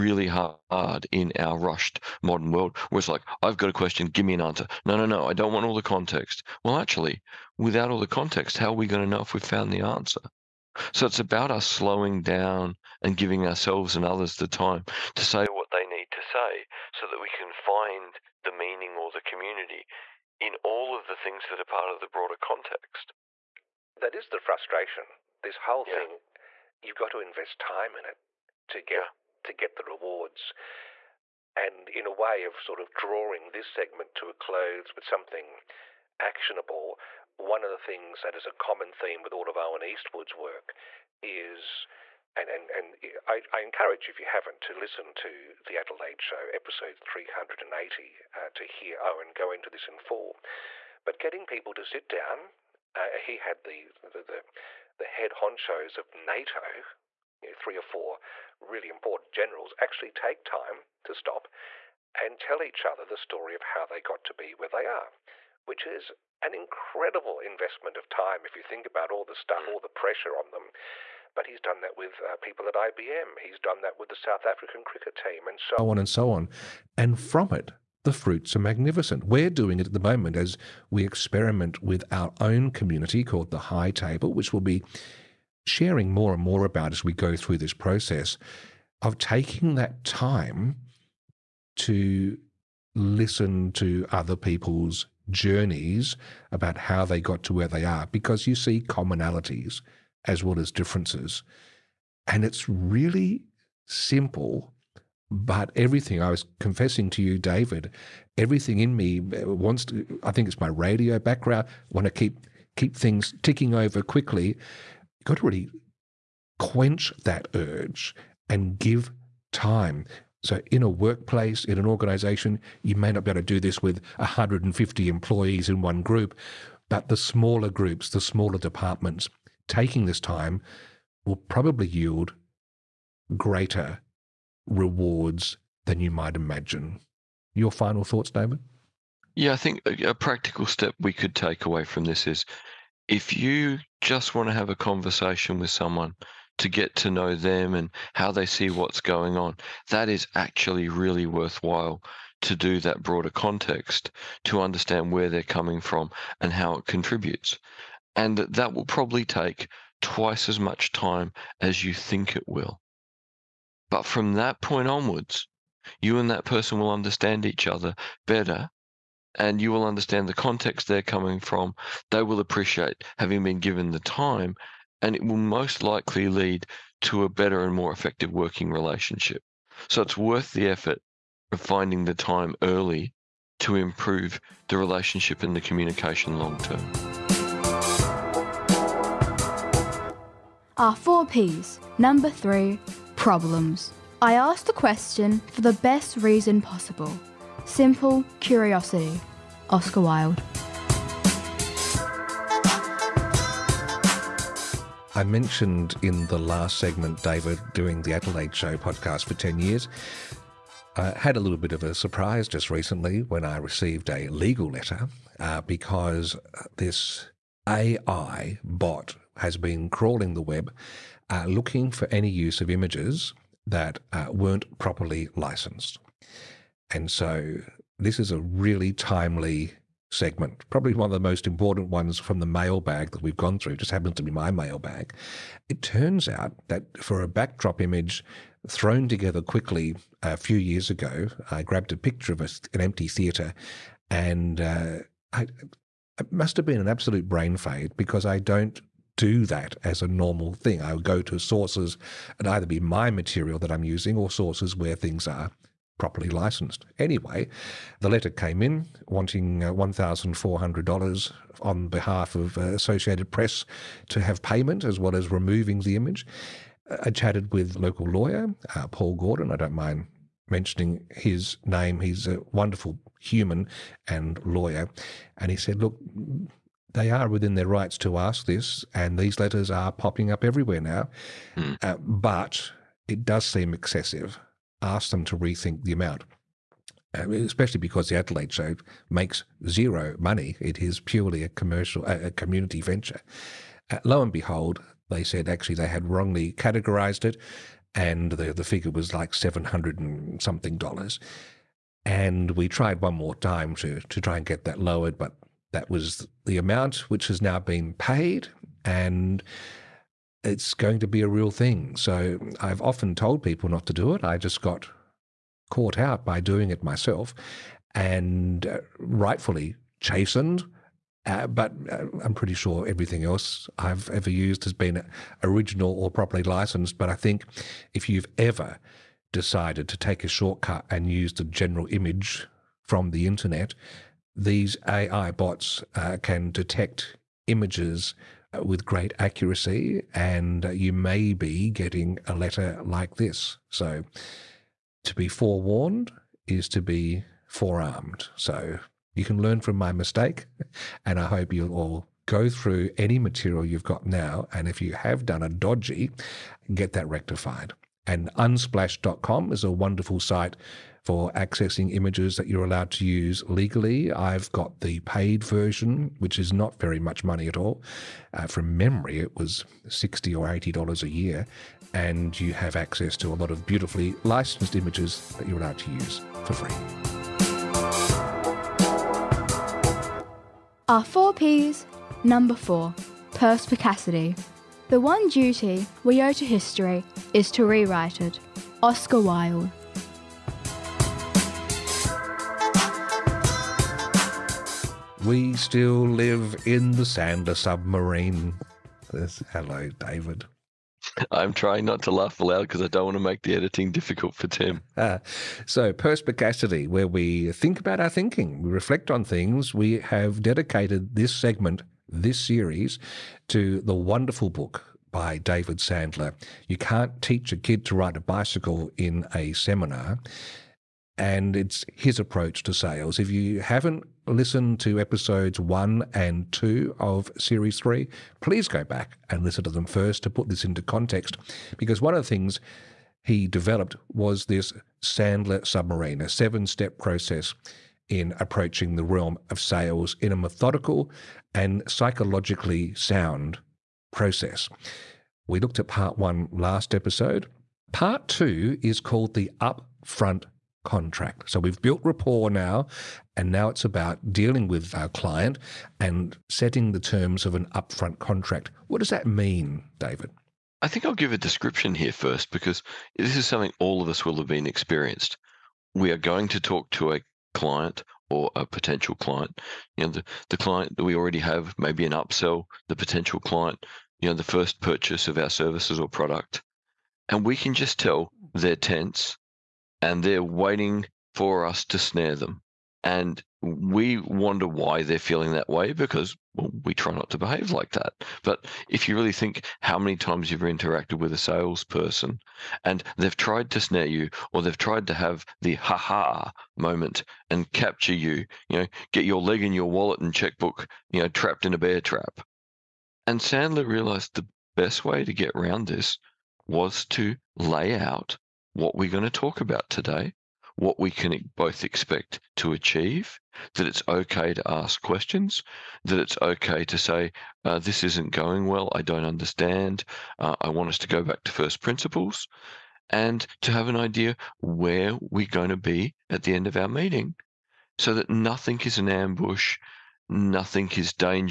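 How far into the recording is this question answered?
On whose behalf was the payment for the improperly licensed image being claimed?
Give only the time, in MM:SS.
04:22.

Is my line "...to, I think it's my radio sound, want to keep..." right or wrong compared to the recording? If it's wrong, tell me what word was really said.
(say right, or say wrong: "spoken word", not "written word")
wrong: "background", not "sound".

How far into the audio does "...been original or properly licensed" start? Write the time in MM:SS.
05:24.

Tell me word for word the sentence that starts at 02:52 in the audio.
They will appreciate having been given the time and it will most likely lead to a better and more effective working relationship.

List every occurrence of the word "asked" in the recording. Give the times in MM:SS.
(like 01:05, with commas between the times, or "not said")
03:14, 04:44.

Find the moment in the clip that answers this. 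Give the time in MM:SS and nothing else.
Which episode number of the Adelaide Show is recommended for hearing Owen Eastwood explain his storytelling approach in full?
00:46.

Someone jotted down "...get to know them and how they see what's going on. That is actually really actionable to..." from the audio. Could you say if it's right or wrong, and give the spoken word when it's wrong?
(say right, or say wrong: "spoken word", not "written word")
wrong: "worthwhile", not "actionable".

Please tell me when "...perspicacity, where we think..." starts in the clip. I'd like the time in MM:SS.
06:45.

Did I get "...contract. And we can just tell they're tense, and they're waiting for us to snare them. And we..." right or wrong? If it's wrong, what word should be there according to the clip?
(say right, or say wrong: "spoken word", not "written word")
wrong: "product", not "contract".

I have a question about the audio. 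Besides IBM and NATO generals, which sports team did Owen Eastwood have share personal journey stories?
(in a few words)
South African cricket team.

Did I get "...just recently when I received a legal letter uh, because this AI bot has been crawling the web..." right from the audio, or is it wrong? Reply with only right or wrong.
right.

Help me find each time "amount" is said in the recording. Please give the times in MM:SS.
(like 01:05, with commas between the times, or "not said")
04:45, 05:06.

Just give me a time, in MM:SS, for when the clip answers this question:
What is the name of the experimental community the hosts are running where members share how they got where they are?
01:23.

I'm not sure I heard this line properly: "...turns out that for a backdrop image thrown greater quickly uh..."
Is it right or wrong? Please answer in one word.
wrong.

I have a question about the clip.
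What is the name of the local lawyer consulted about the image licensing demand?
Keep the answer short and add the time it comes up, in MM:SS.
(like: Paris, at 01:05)
Paul Gordon, at 04:28.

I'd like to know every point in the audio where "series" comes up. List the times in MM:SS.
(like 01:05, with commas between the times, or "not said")
06:52, 07:07.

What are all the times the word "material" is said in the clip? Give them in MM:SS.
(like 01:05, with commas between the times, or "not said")
04:13, 05:53.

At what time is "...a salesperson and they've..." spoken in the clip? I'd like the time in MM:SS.
08:11.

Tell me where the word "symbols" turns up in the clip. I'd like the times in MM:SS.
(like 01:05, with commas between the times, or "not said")
not said.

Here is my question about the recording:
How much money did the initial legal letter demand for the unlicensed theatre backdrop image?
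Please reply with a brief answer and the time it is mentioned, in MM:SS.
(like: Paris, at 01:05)
$1,400, at 04:19.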